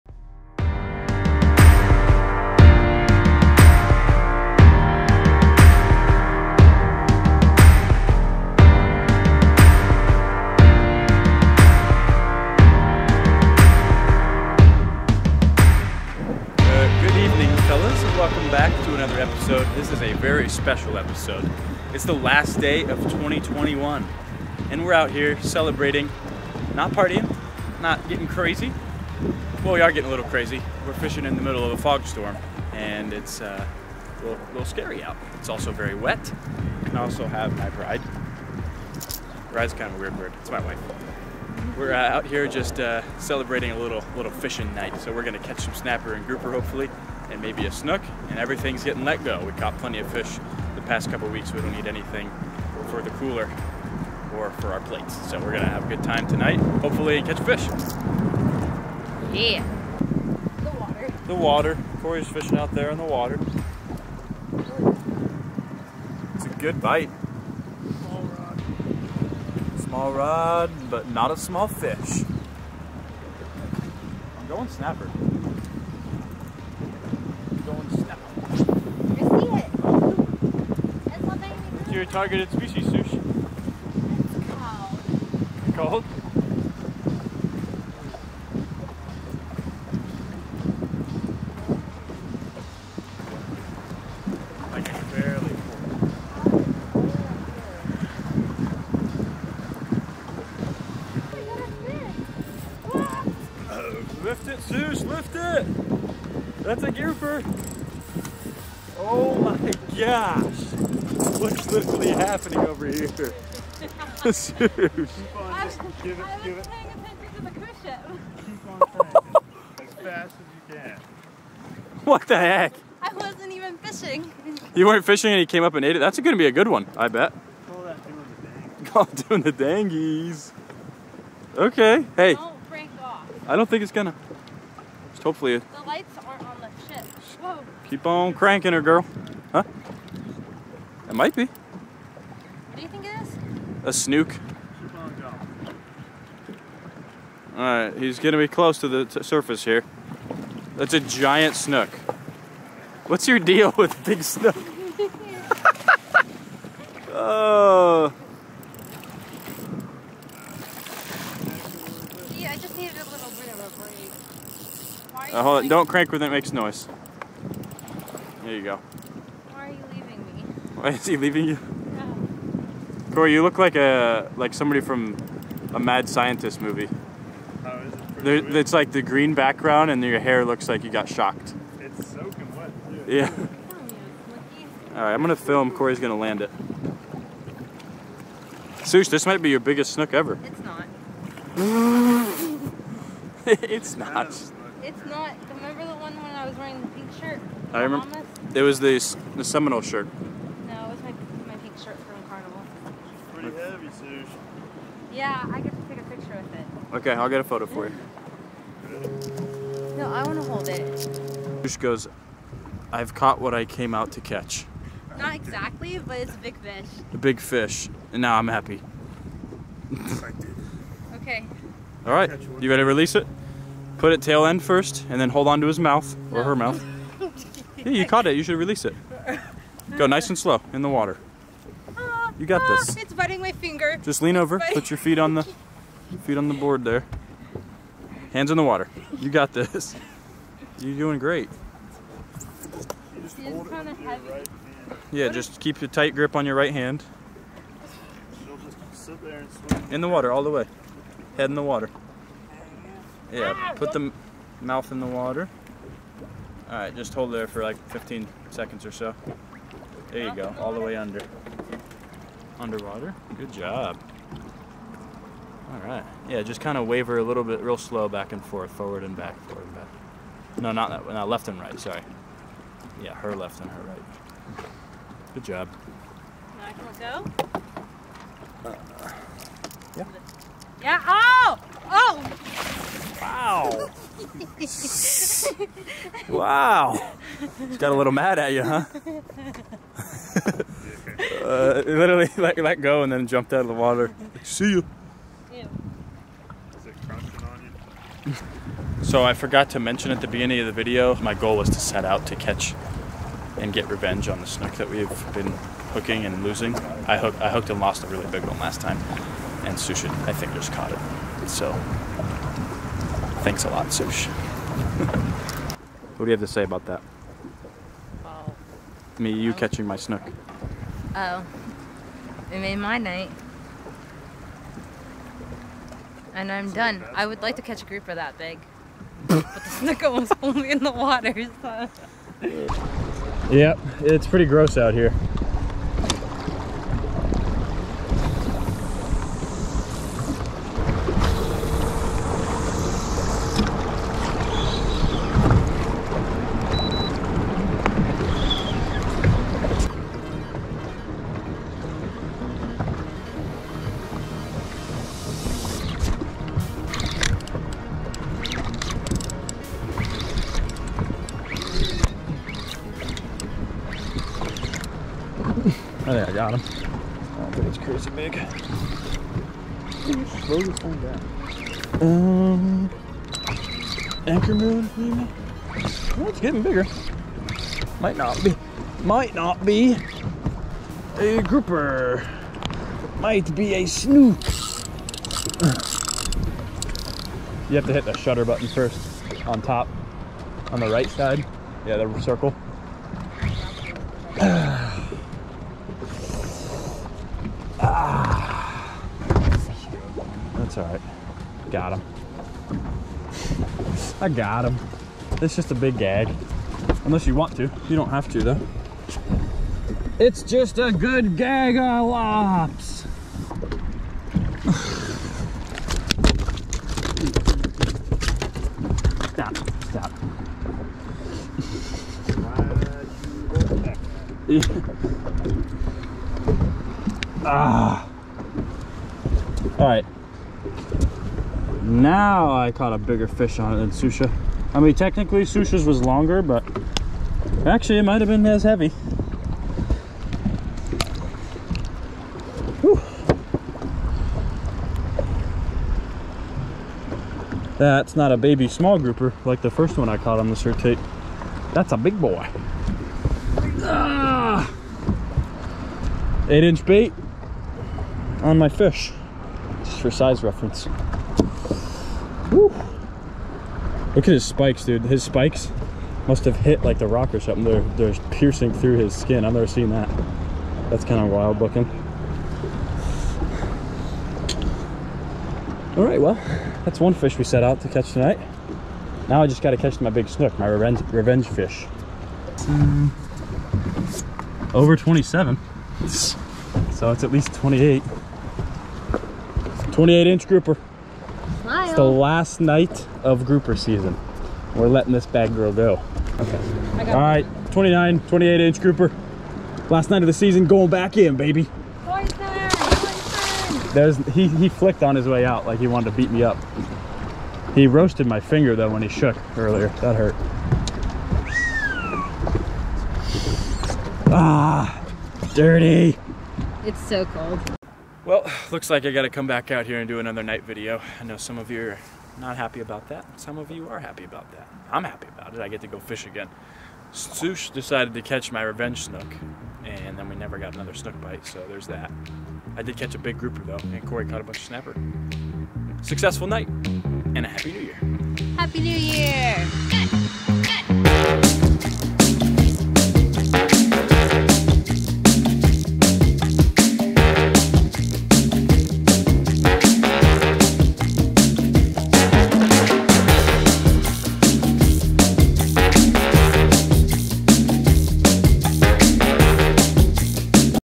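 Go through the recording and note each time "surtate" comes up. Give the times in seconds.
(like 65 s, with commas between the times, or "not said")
450 s.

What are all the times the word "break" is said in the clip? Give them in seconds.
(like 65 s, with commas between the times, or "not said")
132 s, 165 s.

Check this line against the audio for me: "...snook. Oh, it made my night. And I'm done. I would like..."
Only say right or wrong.
right.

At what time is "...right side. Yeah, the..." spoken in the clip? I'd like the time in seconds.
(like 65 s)
390 s.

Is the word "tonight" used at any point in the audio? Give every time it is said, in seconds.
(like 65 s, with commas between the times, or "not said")
56 s, 478 s.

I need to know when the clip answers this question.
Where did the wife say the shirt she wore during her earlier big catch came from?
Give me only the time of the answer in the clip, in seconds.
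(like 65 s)
202 s.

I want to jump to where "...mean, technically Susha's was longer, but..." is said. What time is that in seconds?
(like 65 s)
434 s.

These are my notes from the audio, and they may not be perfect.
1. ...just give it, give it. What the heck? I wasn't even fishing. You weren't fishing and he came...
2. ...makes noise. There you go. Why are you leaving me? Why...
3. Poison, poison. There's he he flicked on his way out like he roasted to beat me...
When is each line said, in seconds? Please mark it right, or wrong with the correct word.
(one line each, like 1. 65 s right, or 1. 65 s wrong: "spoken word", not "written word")
1. 114 s right
2. 166 s right
3. 502 s wrong: "wanted", not "roasted".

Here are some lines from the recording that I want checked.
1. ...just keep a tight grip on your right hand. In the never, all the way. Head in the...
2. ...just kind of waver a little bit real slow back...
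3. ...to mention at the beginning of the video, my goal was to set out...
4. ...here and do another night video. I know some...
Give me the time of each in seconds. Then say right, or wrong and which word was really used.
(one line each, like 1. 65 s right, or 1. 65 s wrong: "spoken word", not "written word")
1. 245 s wrong: "water", not "never"
2. 266 s right
3. 299 s right
4. 519 s right.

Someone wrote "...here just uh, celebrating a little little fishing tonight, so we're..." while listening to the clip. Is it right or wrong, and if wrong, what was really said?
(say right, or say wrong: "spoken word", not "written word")
wrong: "night", not "tonight".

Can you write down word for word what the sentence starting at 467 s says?
They're, they're piercing through his skin.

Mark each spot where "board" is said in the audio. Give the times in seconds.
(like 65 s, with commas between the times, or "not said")
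236 s.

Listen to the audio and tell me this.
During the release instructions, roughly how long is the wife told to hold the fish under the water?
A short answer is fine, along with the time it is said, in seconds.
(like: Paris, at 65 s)
15 seconds, at 257 s.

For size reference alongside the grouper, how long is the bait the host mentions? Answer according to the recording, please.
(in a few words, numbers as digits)
8 inches.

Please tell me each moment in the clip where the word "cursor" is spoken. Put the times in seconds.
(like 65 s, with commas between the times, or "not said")
not said.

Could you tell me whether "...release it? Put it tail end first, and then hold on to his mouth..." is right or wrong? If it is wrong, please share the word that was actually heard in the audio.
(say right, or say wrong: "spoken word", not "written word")
right.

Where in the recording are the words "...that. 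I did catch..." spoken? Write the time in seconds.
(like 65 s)
531 s.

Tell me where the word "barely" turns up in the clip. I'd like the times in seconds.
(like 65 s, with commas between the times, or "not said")
95 s.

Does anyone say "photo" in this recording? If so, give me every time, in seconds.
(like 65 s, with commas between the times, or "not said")
207 s.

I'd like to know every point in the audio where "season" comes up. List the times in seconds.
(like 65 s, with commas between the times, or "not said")
493 s, 500 s.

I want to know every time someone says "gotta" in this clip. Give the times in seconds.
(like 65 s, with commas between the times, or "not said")
519 s.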